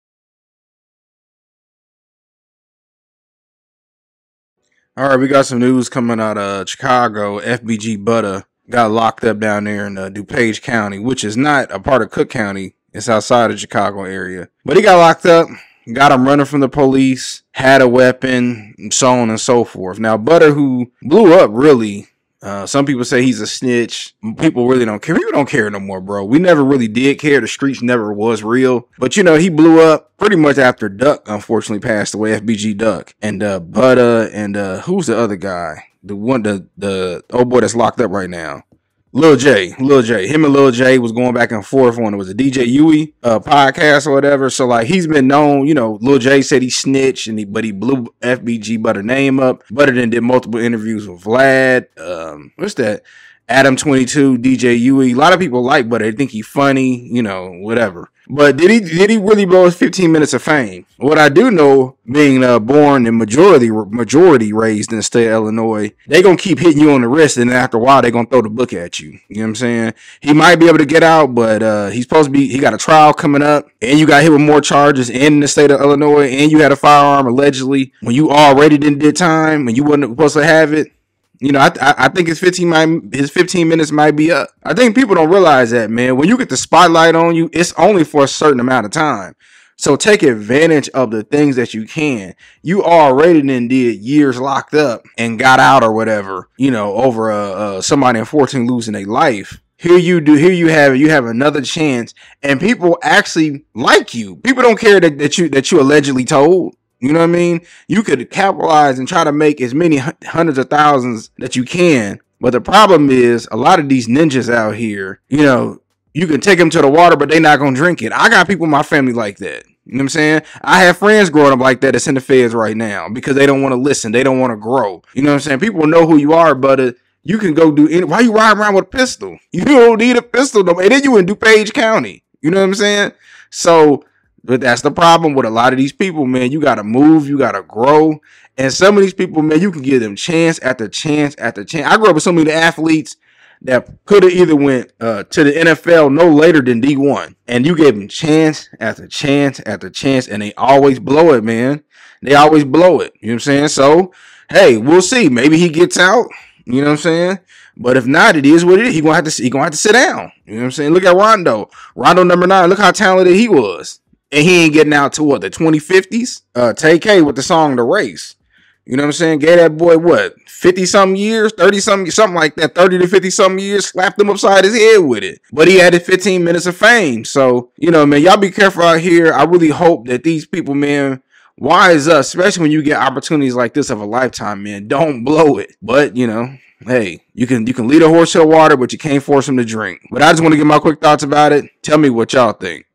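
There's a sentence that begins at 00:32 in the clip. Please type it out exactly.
FBG Duck and uh, Butta and uh, who's the other guy?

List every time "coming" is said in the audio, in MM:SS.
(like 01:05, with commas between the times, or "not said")
00:05, 01:13.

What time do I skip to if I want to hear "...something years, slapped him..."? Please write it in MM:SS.
02:53.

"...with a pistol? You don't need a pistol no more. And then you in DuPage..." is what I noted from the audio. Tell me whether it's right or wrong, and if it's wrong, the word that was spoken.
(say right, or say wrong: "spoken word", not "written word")
right.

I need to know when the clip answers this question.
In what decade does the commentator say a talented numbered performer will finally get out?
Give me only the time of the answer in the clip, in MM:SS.
02:45.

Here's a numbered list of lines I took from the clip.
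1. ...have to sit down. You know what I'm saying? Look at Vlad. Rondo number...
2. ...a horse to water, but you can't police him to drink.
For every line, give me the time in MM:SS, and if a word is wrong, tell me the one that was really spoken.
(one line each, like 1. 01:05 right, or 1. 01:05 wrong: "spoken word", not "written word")
1. 02:39 wrong: "Rondo", not "Vlad"
2. 03:08 wrong: "force", not "police".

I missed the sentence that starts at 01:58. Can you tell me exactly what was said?
I got people in my family like that.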